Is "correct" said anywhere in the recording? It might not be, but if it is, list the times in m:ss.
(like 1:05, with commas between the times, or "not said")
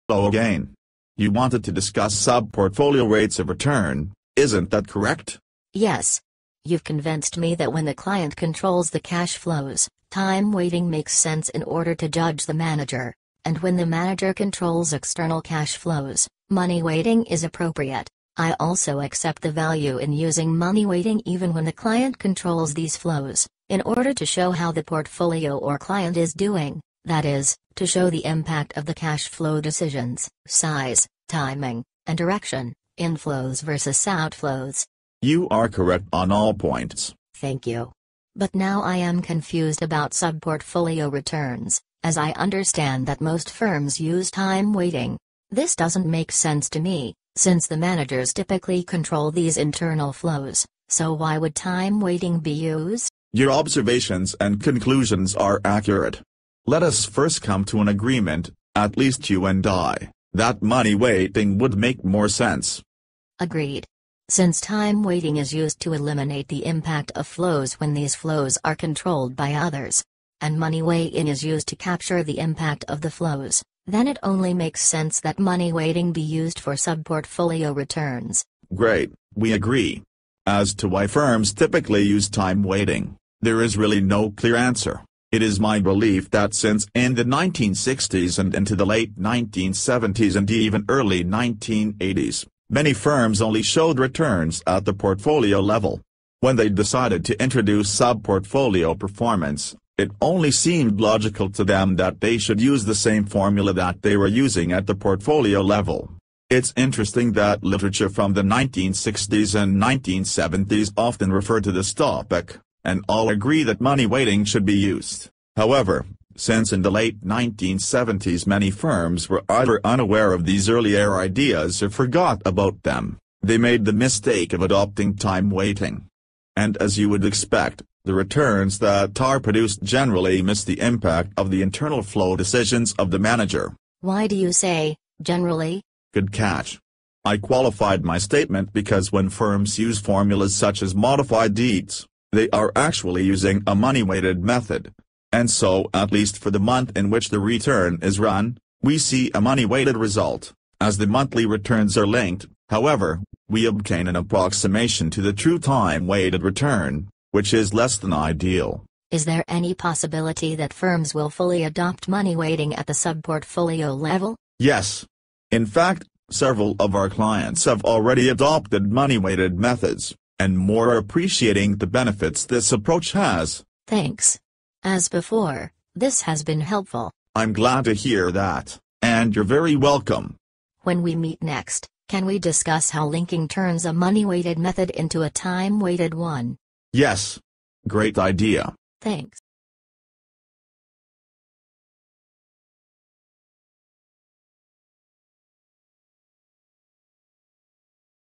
0:04, 0:35.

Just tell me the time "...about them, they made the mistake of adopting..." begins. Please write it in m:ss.
2:02.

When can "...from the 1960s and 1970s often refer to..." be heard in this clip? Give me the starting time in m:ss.
1:48.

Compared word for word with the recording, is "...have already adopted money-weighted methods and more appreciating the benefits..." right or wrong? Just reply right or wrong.
right.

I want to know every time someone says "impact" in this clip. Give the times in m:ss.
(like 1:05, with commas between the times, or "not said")
0:28, 1:06, 1:12, 2:10.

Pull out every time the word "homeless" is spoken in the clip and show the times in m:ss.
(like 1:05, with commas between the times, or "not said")
not said.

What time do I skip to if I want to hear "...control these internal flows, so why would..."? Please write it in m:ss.
0:48.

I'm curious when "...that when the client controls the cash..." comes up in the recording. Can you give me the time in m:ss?
0:07.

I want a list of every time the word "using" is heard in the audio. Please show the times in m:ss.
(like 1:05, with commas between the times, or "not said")
0:20, 1:44, 2:23.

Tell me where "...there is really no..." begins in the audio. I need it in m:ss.
1:23.